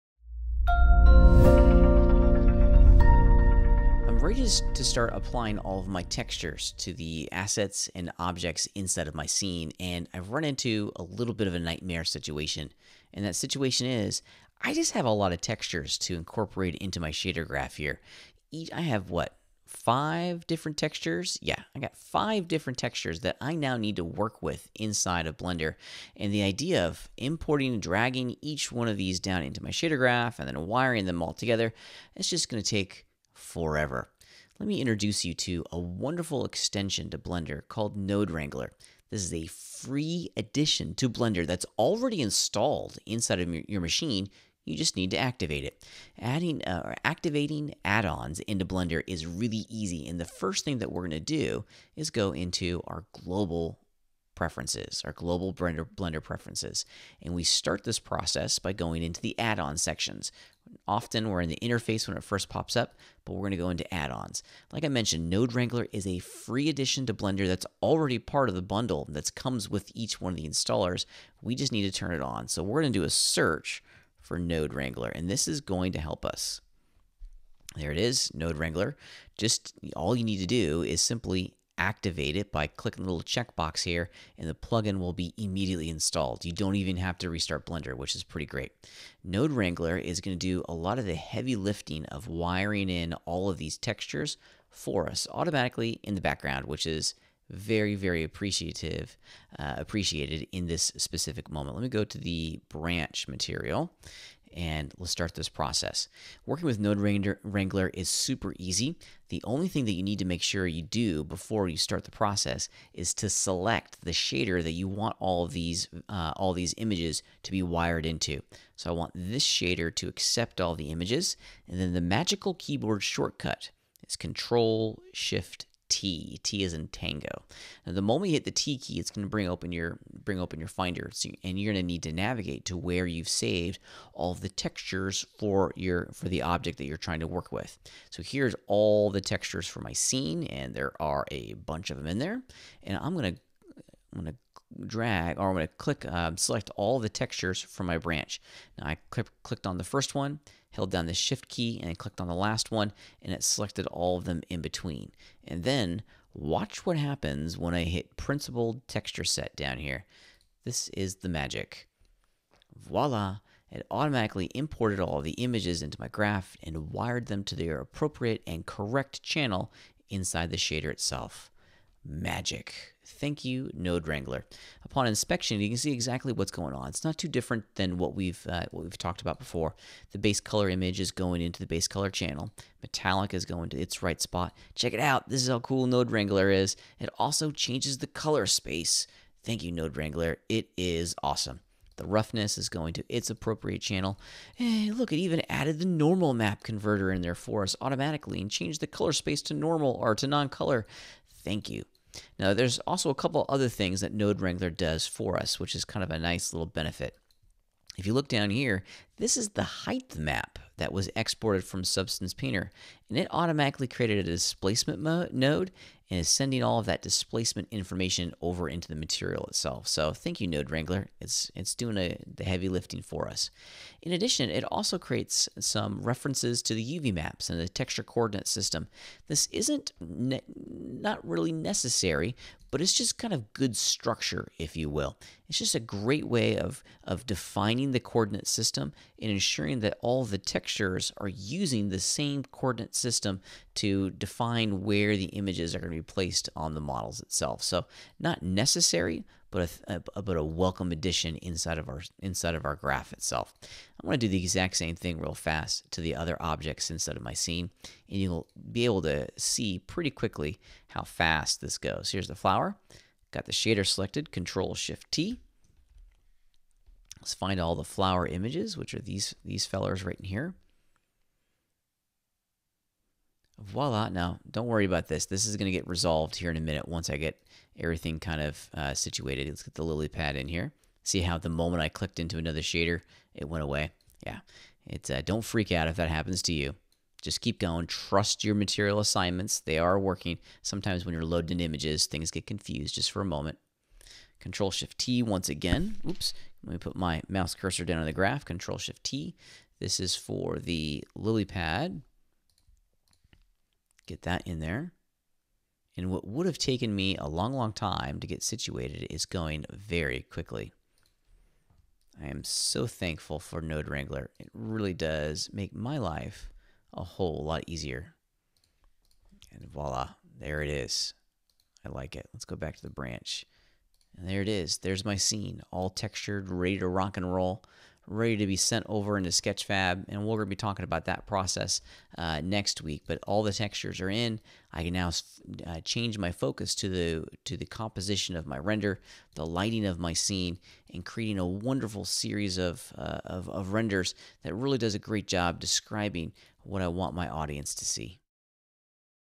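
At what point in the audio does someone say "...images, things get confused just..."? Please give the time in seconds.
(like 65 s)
291 s.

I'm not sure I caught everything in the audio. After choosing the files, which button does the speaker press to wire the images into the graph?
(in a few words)
principled texture set.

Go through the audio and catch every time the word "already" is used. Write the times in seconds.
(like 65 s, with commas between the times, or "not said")
41 s, 67 s.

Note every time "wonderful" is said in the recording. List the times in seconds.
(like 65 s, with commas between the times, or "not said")
35 s, 341 s.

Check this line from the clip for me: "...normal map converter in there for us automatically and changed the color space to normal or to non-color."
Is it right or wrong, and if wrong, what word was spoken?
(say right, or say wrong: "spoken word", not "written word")
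right.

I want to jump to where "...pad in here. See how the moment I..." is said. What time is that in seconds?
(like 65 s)
280 s.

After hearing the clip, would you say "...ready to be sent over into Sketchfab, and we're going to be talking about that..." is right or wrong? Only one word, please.
right.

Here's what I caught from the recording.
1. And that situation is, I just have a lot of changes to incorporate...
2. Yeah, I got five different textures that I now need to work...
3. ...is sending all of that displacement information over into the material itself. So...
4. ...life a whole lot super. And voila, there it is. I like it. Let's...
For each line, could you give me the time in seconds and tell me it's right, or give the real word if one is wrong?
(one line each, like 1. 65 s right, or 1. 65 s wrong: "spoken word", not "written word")
1. 13 s wrong: "textures", not "changes"
2. 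21 s right
3. 216 s right
4. 315 s wrong: "easier", not "super".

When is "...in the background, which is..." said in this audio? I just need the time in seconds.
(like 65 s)
96 s.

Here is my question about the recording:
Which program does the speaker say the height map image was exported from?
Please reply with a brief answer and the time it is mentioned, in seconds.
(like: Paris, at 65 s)
Substance Painter, at 211 s.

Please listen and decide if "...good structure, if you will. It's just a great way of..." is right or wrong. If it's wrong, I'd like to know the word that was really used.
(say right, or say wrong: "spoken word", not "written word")
right.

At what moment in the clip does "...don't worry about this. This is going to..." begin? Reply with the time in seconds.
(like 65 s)
274 s.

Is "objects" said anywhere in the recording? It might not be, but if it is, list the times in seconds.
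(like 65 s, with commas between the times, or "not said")
8 s, 136 s, 256 s.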